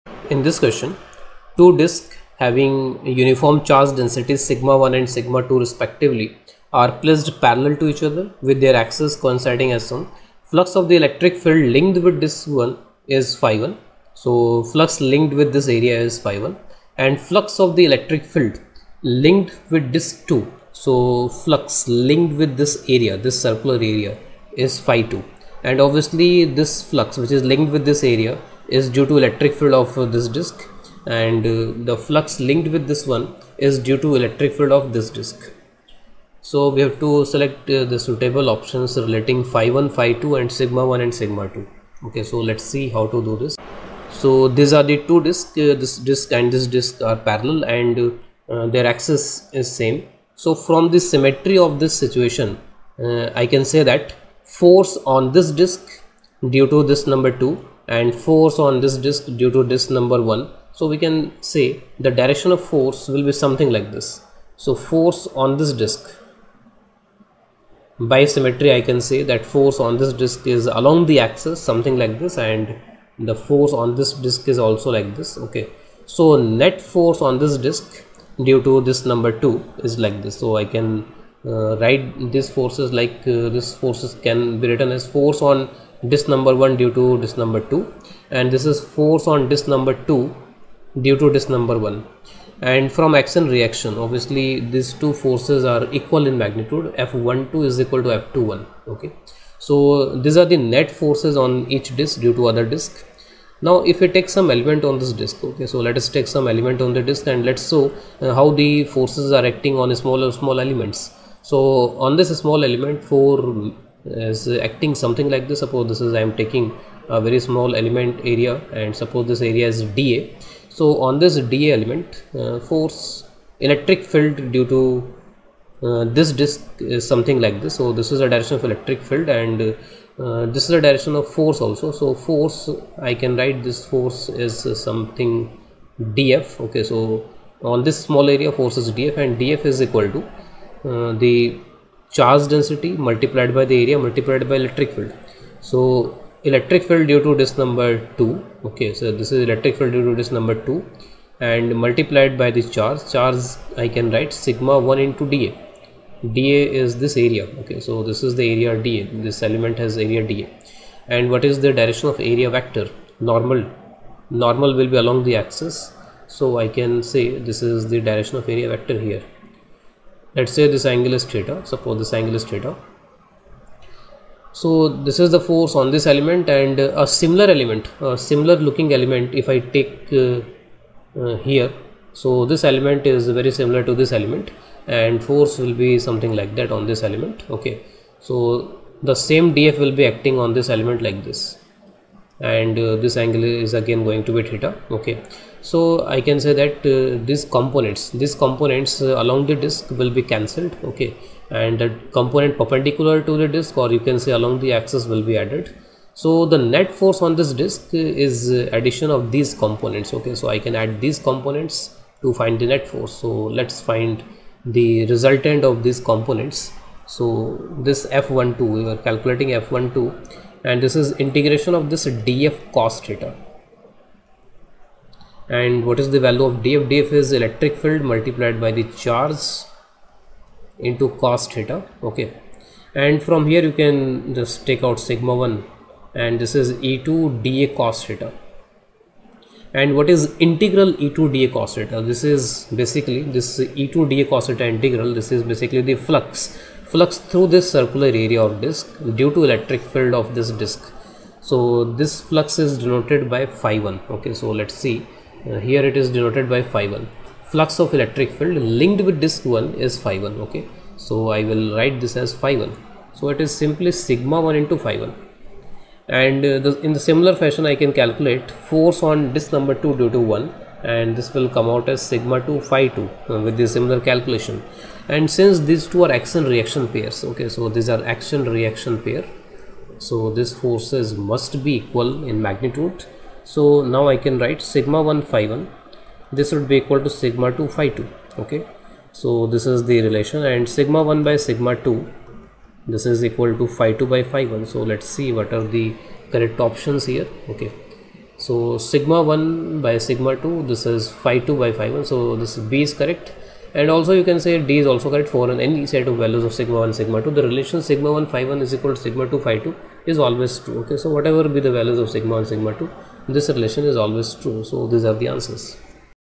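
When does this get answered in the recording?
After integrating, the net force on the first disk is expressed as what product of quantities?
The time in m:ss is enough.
4:23.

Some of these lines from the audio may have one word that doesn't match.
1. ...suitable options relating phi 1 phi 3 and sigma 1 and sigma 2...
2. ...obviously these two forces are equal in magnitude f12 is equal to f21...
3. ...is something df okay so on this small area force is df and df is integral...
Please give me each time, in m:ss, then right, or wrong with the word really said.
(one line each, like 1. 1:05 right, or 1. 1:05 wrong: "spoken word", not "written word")
1. 0:37 wrong: "2", not "3"
2. 1:33 right
3. 2:14 wrong: "equal", not "integral".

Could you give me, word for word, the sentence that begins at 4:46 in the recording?
this would be equal to sigma 2 phi 2.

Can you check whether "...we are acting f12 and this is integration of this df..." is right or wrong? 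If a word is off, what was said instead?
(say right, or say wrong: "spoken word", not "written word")
wrong: "calculating", not "acting".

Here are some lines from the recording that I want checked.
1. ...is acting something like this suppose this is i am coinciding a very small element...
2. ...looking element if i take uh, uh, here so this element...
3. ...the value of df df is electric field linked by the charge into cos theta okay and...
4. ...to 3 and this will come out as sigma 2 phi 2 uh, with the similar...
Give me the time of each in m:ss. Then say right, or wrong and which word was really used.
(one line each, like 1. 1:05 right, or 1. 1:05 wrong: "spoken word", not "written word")
1. 1:54 wrong: "taking", not "coinciding"
2. 2:58 right
3. 3:46 wrong: "multiplied", not "linked"
4. 4:30 wrong: "1", not "3".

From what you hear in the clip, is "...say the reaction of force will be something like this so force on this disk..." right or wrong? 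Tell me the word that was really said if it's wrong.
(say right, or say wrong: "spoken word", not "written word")
wrong: "direction", not "reaction".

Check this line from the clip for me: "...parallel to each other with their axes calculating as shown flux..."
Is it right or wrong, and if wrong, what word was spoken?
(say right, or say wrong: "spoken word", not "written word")
wrong: "coinciding", not "calculating".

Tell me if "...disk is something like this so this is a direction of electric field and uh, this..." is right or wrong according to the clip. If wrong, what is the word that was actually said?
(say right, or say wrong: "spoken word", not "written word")
right.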